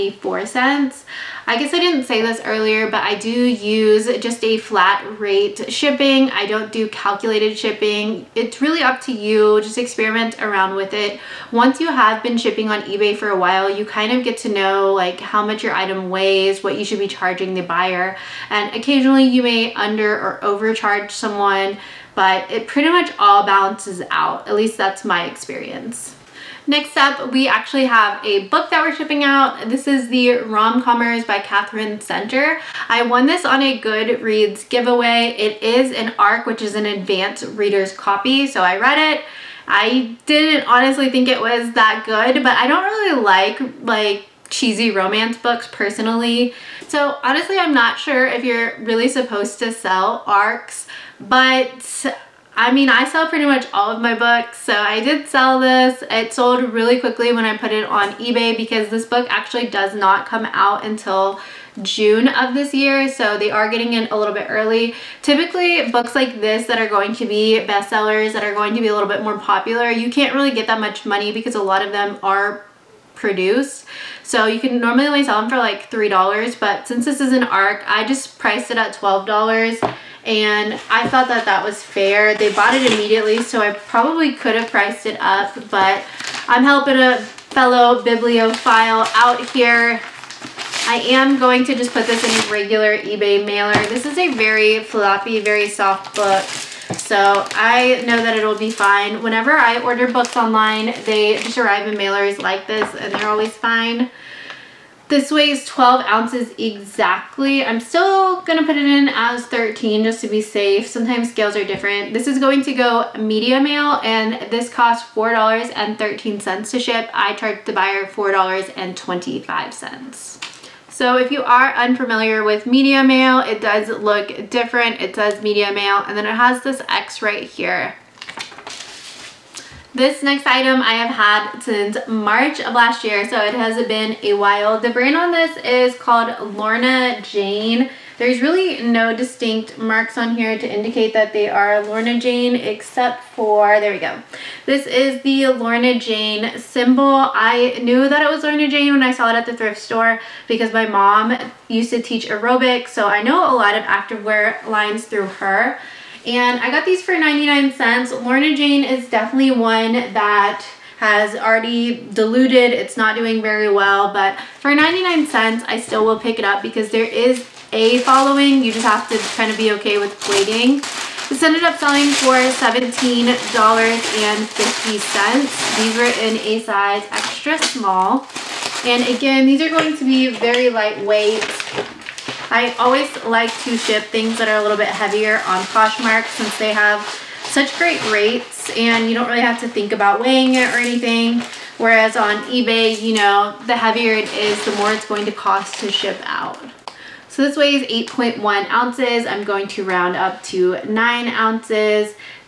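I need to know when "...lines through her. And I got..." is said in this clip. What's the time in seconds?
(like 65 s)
154 s.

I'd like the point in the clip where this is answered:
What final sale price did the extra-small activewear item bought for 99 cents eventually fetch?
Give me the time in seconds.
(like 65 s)
172 s.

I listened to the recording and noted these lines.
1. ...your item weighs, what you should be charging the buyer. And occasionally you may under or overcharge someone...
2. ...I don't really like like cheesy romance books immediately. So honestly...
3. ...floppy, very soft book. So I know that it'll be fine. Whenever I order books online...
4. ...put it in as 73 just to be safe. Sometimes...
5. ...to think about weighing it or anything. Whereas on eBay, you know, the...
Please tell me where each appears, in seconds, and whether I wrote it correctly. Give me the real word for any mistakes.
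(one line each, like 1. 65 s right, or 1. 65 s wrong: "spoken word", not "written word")
1. 15 s right
2. 42 s wrong: "personally", not "immediately"
3. 94 s right
4. 108 s wrong: "13", not "73"
5. 189 s right.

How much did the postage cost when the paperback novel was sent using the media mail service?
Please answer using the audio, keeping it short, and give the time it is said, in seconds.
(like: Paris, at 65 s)
$4.13, at 115 s.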